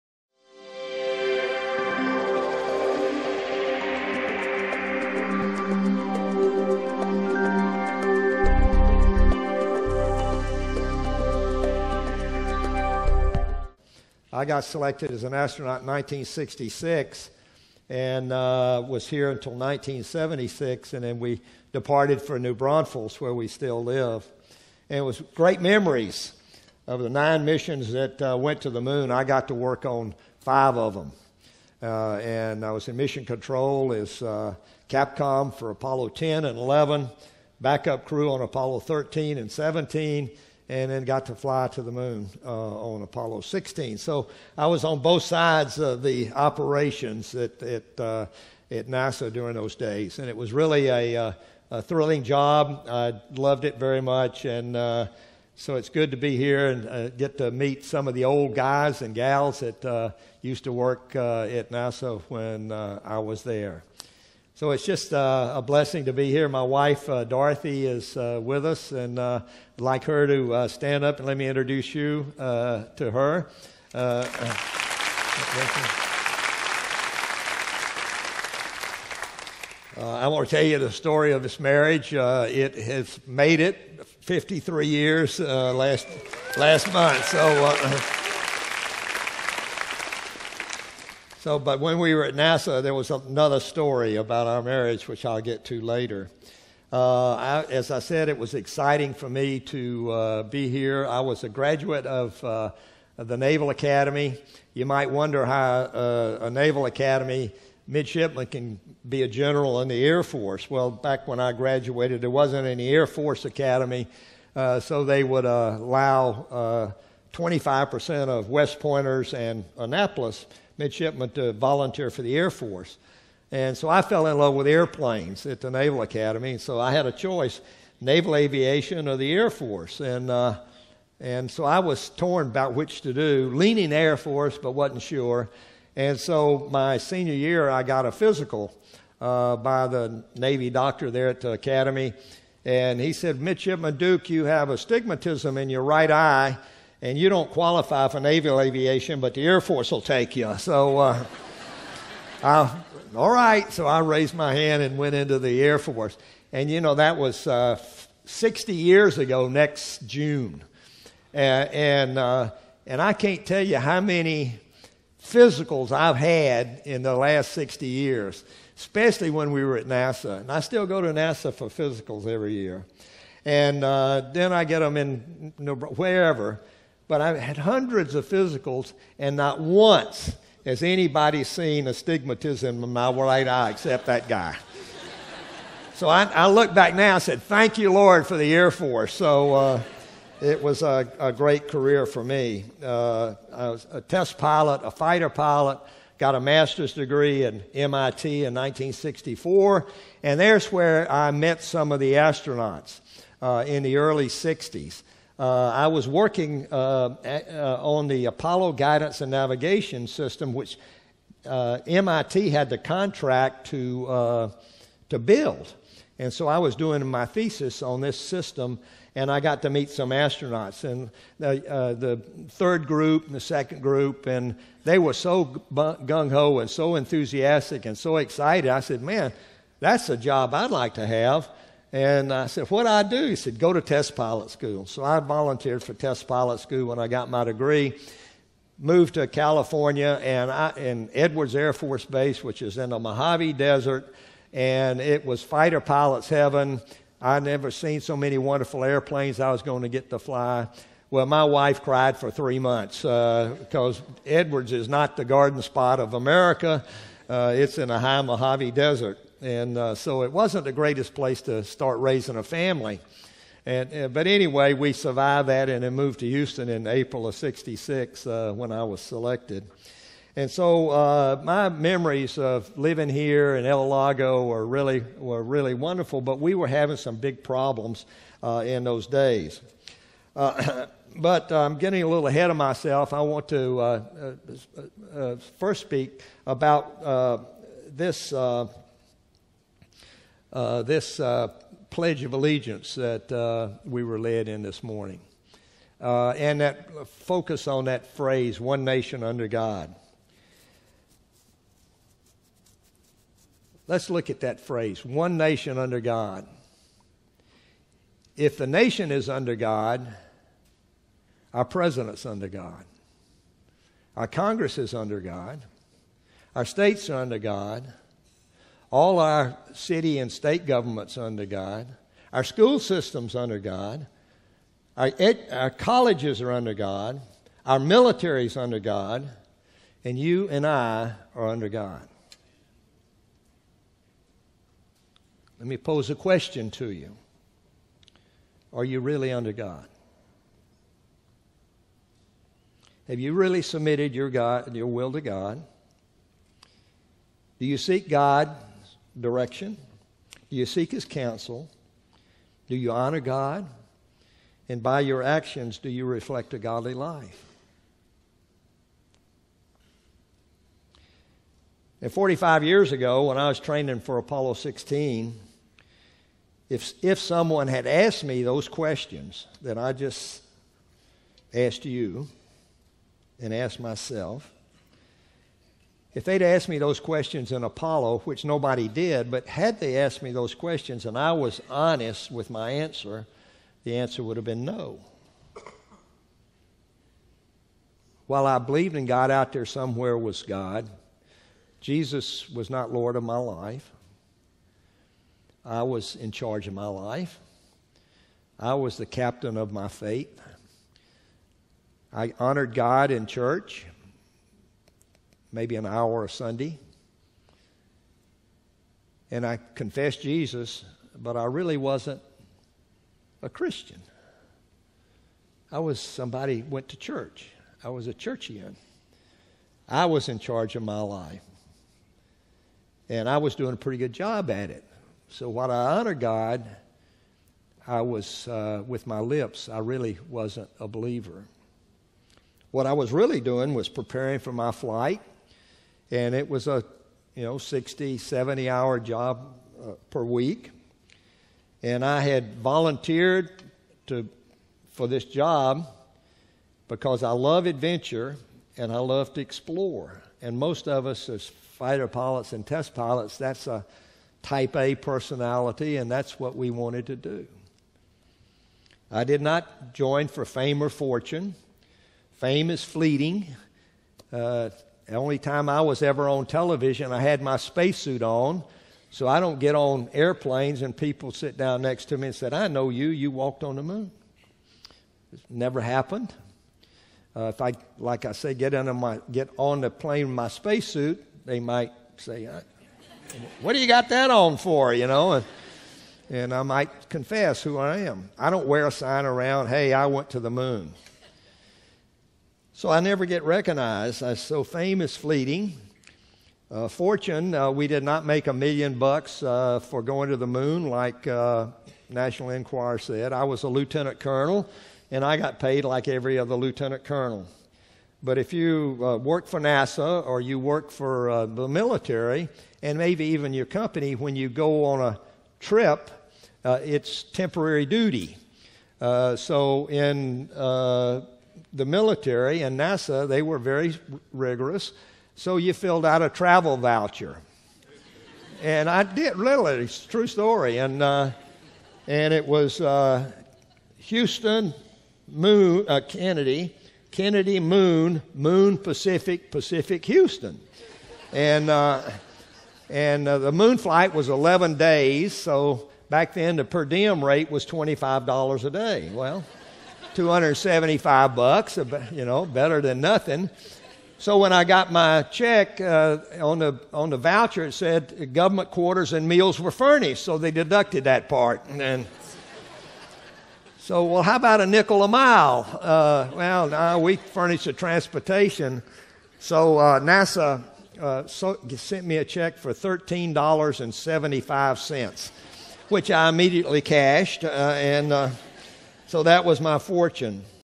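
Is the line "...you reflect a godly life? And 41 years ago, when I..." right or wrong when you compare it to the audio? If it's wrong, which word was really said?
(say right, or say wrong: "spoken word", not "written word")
wrong: "45", not "41".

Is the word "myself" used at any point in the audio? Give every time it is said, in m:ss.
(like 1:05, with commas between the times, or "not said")
4:42, 6:13.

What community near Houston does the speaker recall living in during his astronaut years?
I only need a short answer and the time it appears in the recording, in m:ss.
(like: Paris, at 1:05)
El Lago, at 4:33.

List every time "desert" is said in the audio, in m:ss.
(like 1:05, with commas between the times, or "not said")
4:03, 4:18.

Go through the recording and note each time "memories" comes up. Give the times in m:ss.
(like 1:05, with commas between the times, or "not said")
0:25, 4:31.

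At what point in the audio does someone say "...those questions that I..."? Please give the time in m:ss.
6:08.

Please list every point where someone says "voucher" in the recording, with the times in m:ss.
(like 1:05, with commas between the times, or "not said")
8:46, 9:17.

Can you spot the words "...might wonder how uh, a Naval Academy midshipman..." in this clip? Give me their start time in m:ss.
1:44.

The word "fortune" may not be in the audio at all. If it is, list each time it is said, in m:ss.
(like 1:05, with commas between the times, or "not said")
7:40, 8:16, 9:39.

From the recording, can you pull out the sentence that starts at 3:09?
So uh, it was a, a, great career for me.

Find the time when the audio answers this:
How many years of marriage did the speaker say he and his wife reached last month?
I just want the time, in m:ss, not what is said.
1:24.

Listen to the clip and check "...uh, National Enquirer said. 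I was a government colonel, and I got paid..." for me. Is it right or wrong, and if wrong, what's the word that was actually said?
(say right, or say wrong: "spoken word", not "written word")
wrong: "lieutenant", not "government".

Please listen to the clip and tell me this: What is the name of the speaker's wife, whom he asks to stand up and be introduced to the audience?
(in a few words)
Dorothy.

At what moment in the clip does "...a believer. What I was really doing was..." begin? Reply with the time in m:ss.
7:10.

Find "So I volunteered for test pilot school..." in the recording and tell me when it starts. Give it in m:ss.
3:54.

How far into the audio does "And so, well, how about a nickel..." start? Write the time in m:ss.
9:21.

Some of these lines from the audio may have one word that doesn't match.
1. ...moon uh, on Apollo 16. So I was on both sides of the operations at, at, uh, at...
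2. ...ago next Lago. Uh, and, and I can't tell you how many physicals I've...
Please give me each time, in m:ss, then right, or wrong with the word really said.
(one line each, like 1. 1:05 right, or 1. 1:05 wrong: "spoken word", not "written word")
1. 0:41 right
2. 2:39 wrong: "June", not "Lago".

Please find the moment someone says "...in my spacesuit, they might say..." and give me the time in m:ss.
8:00.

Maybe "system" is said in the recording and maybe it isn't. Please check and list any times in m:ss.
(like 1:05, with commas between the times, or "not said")
3:30, 3:38, 5:22.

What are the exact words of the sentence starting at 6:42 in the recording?
I honored God in church maybe an hour a Sunday.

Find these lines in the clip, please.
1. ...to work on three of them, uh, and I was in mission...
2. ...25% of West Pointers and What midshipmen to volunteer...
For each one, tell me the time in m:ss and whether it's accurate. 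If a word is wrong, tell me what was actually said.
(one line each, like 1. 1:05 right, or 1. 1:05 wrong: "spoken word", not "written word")
1. 0:29 wrong: "five", not "three"
2. 1:57 wrong: "Annapolis", not "What".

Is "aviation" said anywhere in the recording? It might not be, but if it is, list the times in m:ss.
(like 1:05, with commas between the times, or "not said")
2:08, 2:28.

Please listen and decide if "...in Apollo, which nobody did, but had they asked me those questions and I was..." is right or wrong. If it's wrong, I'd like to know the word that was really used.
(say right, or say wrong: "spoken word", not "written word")
right.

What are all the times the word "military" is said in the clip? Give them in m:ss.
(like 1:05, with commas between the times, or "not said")
5:27, 8:31, 8:41.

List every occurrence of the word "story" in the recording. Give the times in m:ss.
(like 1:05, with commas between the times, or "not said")
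1:20, 1:33, 8:50.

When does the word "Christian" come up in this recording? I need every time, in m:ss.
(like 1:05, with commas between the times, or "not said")
6:53.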